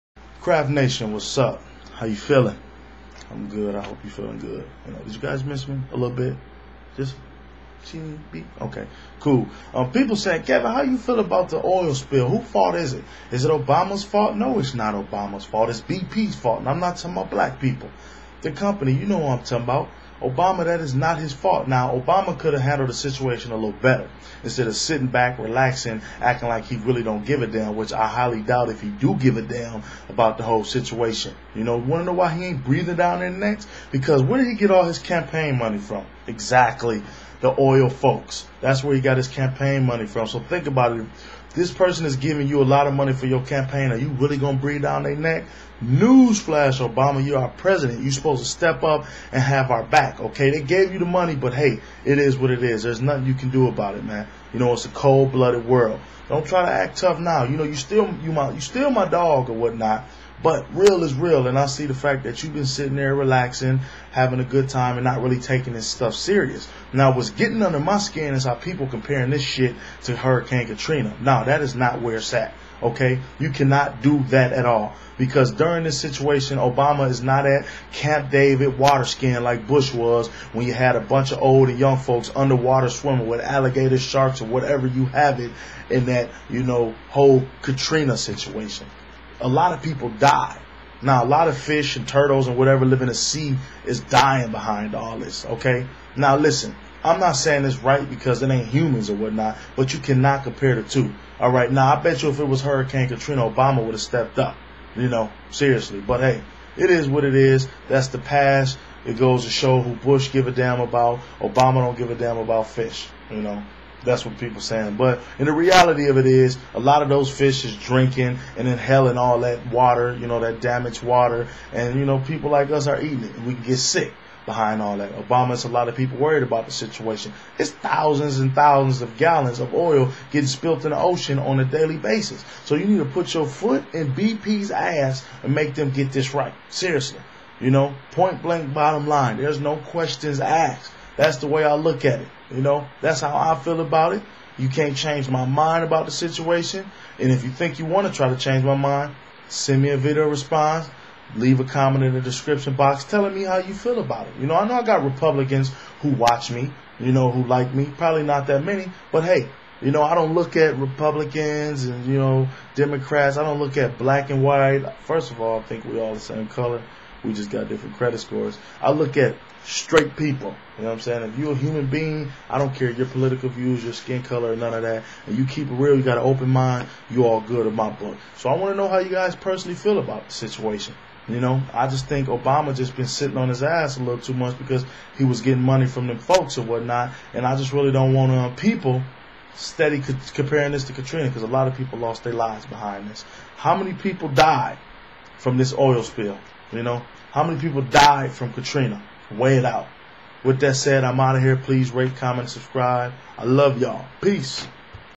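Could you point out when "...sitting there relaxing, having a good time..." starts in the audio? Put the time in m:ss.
1:02.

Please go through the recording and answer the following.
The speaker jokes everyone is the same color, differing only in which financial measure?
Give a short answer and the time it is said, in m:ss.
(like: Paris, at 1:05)
Credit scores, at 2:47.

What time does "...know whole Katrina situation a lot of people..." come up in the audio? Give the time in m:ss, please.
1:26.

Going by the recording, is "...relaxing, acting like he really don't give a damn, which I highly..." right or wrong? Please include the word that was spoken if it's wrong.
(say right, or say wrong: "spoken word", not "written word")
right.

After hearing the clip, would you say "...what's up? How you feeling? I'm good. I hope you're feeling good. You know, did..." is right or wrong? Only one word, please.
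right.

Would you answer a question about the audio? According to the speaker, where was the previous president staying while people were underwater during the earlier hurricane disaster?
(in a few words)
Camp David.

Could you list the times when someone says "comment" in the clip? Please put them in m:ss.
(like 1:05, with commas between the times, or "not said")
2:31, 3:22.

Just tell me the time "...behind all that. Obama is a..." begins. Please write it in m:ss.
2:04.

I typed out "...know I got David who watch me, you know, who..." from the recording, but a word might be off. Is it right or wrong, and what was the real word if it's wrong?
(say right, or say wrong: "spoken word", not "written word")
wrong: "Republicans", not "David".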